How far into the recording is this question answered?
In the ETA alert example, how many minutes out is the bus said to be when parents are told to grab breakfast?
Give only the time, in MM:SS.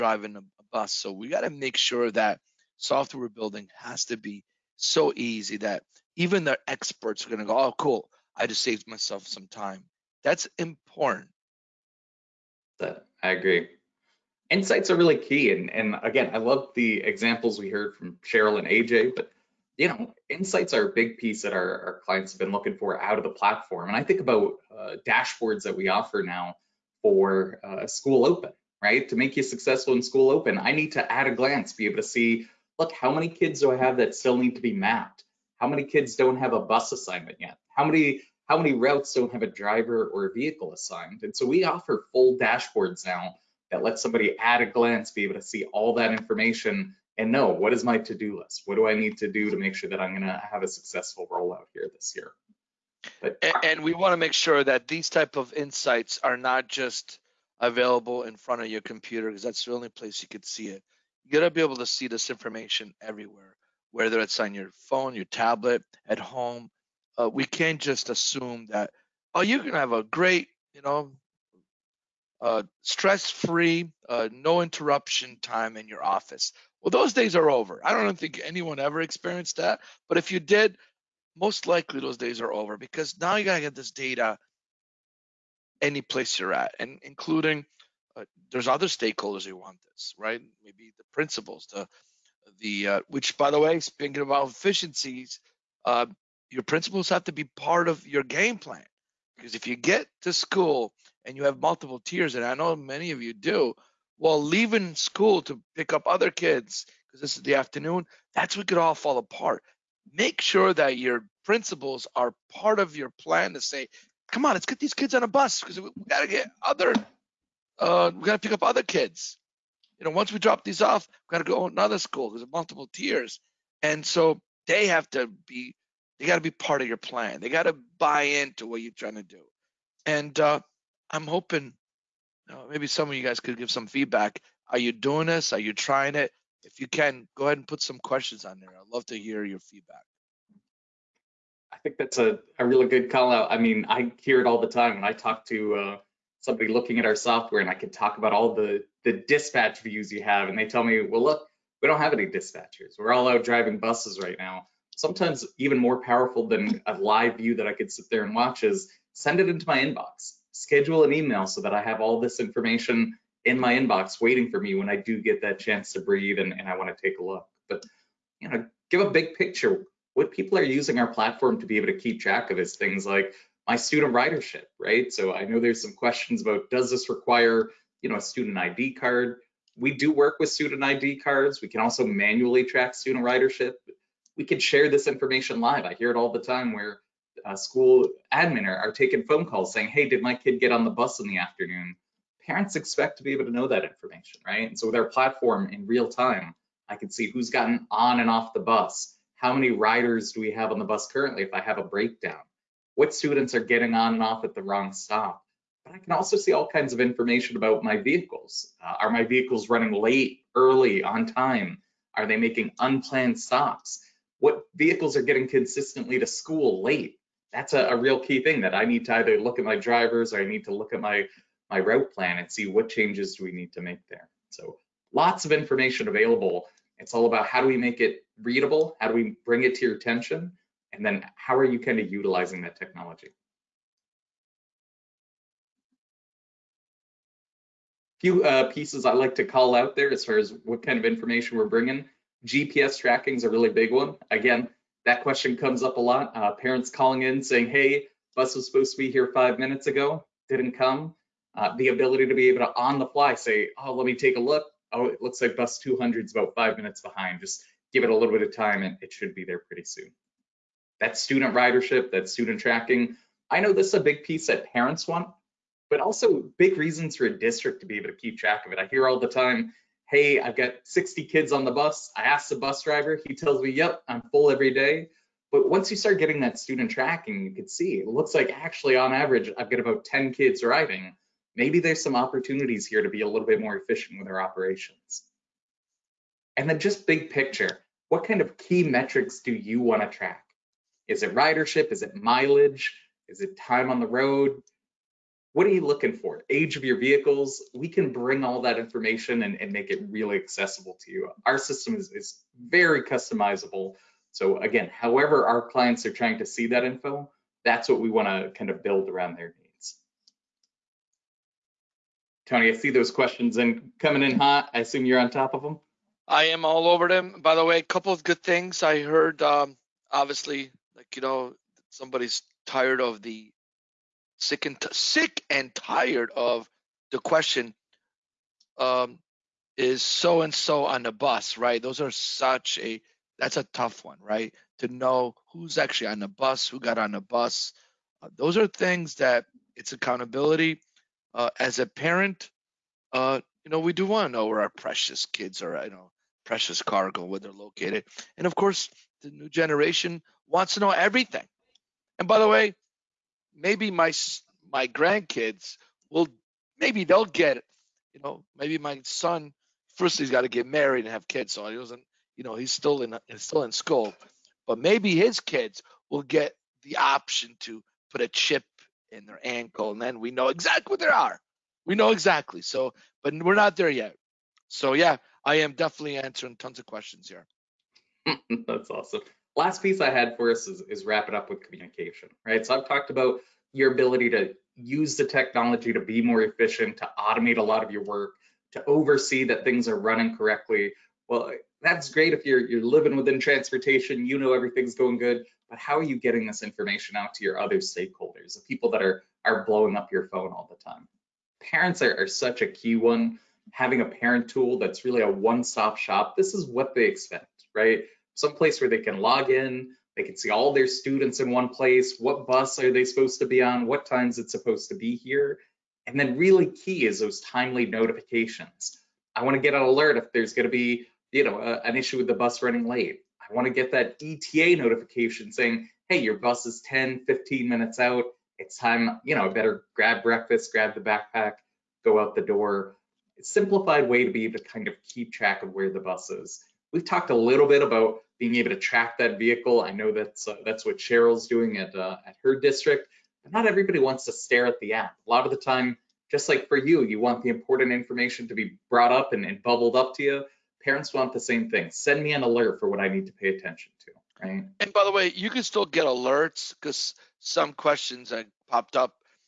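07:06.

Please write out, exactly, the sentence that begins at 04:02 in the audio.
GPS tracking is a really big one.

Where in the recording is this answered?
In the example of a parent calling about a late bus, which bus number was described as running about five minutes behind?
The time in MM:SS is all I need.
04:15.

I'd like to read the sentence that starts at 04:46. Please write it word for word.
And then just big picture, what kind of key metrics do you want to track?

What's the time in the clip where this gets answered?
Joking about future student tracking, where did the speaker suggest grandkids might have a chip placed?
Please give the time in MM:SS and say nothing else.
06:09.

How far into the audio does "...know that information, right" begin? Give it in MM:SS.
03:13.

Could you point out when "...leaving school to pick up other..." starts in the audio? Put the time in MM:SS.
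01:44.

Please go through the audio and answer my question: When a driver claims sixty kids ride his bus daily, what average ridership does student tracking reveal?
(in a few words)
10.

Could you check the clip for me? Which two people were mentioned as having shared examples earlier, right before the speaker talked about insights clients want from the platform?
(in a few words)
Cheryl and AJ.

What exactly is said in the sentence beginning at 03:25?
But I can also see all kinds of information about my vehicles.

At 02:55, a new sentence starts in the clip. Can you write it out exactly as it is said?
So I know there's some questions about does this require, you know, a student ID card?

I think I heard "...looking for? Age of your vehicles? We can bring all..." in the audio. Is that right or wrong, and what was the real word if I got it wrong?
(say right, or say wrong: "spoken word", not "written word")
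right.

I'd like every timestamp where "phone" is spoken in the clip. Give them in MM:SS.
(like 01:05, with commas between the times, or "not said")
01:04, 03:09, 06:40.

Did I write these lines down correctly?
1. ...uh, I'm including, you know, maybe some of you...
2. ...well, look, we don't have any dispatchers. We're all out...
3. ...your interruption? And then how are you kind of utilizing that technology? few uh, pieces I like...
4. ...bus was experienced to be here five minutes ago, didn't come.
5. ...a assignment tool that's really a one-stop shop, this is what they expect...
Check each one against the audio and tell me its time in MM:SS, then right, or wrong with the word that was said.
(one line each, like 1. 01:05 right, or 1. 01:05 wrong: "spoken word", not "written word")
1. 02:10 wrong: "hoping", not "including"
2. 02:31 right
3. 03:49 wrong: "attention", not "interruption"
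4. 04:08 wrong: "supposed", not "experienced"
5. 06:44 wrong: "parent", not "assignment".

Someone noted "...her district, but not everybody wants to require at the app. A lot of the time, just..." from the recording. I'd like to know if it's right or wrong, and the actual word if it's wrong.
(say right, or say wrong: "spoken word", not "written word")
wrong: "stare", not "require".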